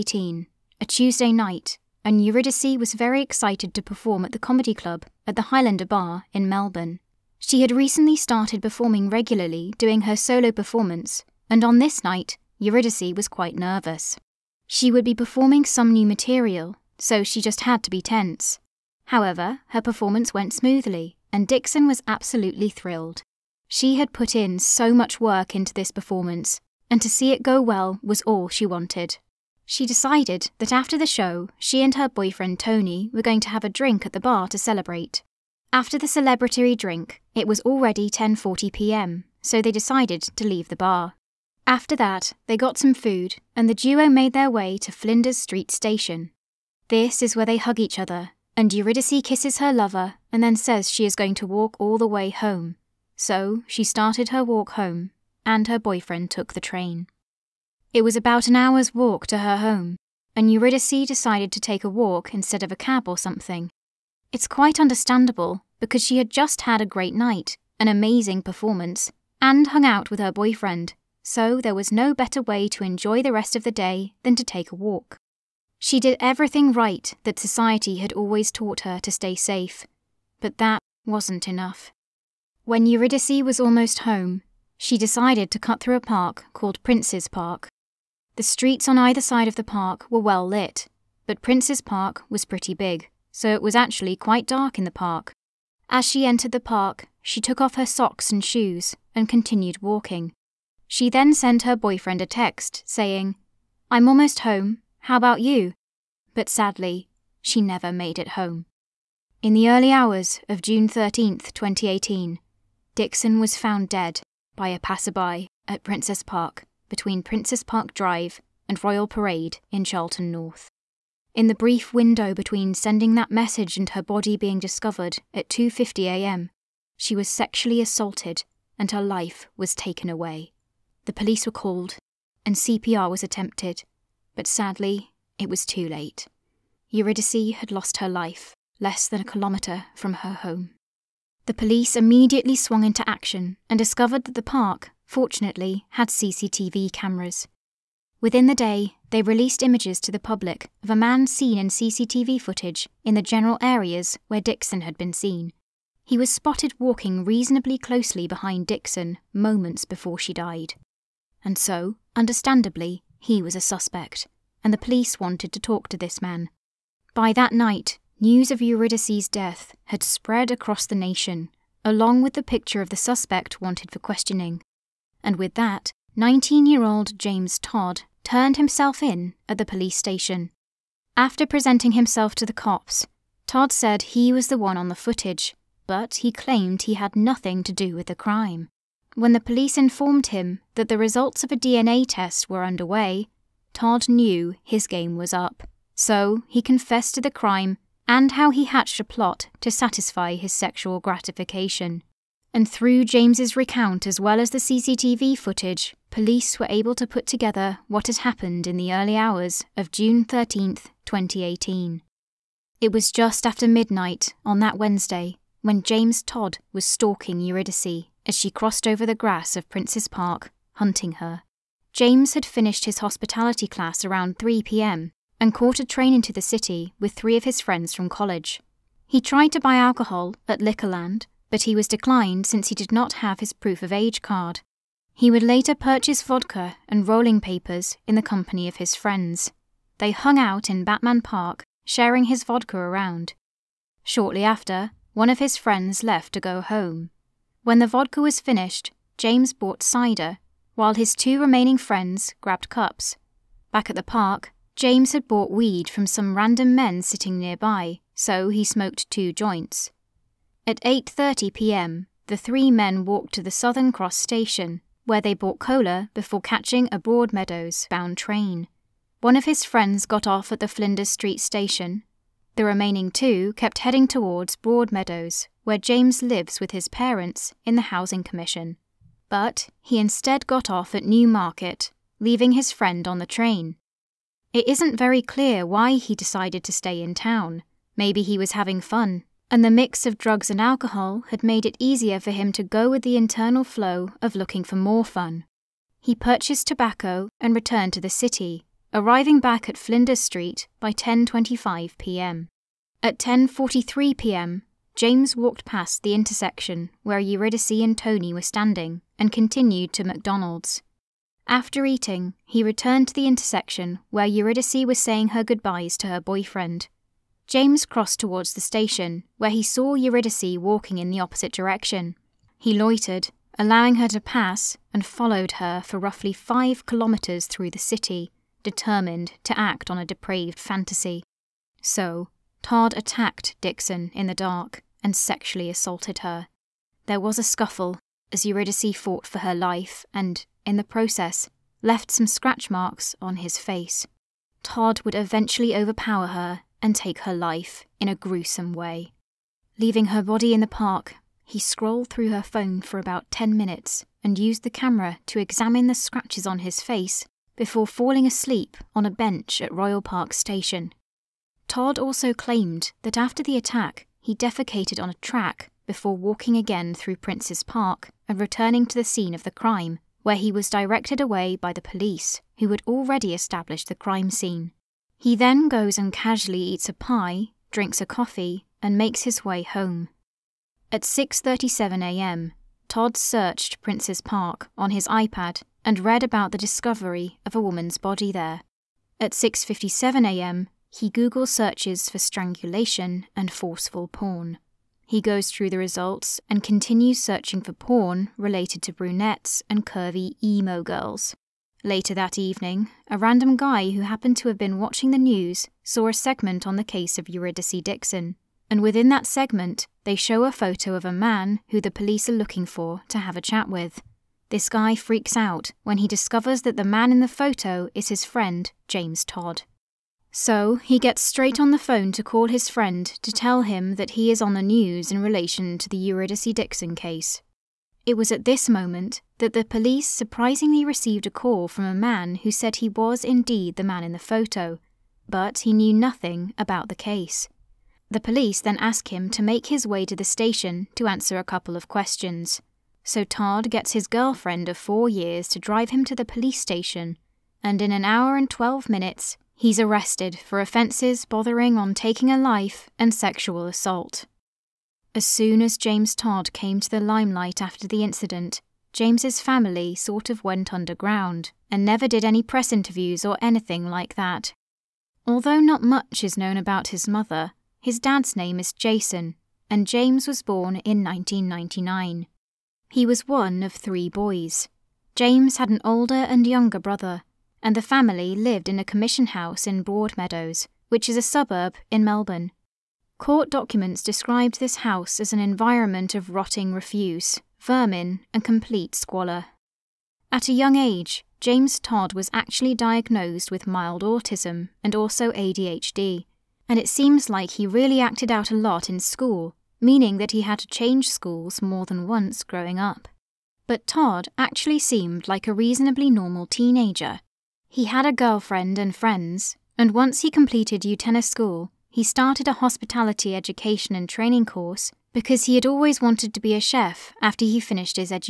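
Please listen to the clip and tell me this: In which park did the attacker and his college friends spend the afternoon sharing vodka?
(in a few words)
Batman Park.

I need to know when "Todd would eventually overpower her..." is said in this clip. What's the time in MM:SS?
05:44.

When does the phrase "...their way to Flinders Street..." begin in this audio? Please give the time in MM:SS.
00:44.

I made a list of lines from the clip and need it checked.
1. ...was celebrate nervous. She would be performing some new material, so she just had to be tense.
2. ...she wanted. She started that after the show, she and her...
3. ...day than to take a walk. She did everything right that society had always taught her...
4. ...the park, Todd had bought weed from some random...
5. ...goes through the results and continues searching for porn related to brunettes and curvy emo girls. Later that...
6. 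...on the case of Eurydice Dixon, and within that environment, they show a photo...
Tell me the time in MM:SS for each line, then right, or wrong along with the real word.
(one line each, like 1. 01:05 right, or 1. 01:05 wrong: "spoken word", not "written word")
1. 00:13 wrong: "quite", not "celebrate"
2. 00:28 wrong: "decided", not "started"
3. 01:13 right
4. 04:13 wrong: "James", not "Todd"
5. 06:35 right
6. 06:46 wrong: "segment", not "environment".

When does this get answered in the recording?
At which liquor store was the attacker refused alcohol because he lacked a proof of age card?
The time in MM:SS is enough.
03:50.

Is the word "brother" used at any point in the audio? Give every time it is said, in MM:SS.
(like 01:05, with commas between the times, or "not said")
07:56.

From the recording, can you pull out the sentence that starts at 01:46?
But sadly, she never made it home.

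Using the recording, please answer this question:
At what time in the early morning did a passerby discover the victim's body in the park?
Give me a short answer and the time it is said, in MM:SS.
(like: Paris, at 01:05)
2:50 a.m., at 02:05.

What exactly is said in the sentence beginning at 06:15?
He then goes and casually eats a pie, drinks a coffee, and makes his way home.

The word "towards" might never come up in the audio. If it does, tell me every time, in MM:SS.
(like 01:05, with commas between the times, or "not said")
04:34, 05:18.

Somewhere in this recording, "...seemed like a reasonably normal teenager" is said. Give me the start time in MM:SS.
08:24.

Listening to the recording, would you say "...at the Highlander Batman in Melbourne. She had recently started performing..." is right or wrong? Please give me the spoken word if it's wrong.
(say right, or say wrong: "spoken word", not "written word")
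wrong: "Bar", not "Batman".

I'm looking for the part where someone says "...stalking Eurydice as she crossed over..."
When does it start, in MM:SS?
03:36.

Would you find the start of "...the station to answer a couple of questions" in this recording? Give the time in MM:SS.
07:20.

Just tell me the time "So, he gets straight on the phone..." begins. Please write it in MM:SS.
07:00.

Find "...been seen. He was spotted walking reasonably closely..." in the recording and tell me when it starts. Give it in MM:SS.
02:34.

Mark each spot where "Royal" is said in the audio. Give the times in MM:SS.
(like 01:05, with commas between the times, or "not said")
01:58, 05:59.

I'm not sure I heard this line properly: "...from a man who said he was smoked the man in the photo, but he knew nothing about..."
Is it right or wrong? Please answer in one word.
wrong.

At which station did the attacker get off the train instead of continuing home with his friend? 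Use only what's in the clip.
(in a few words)
Newmarket.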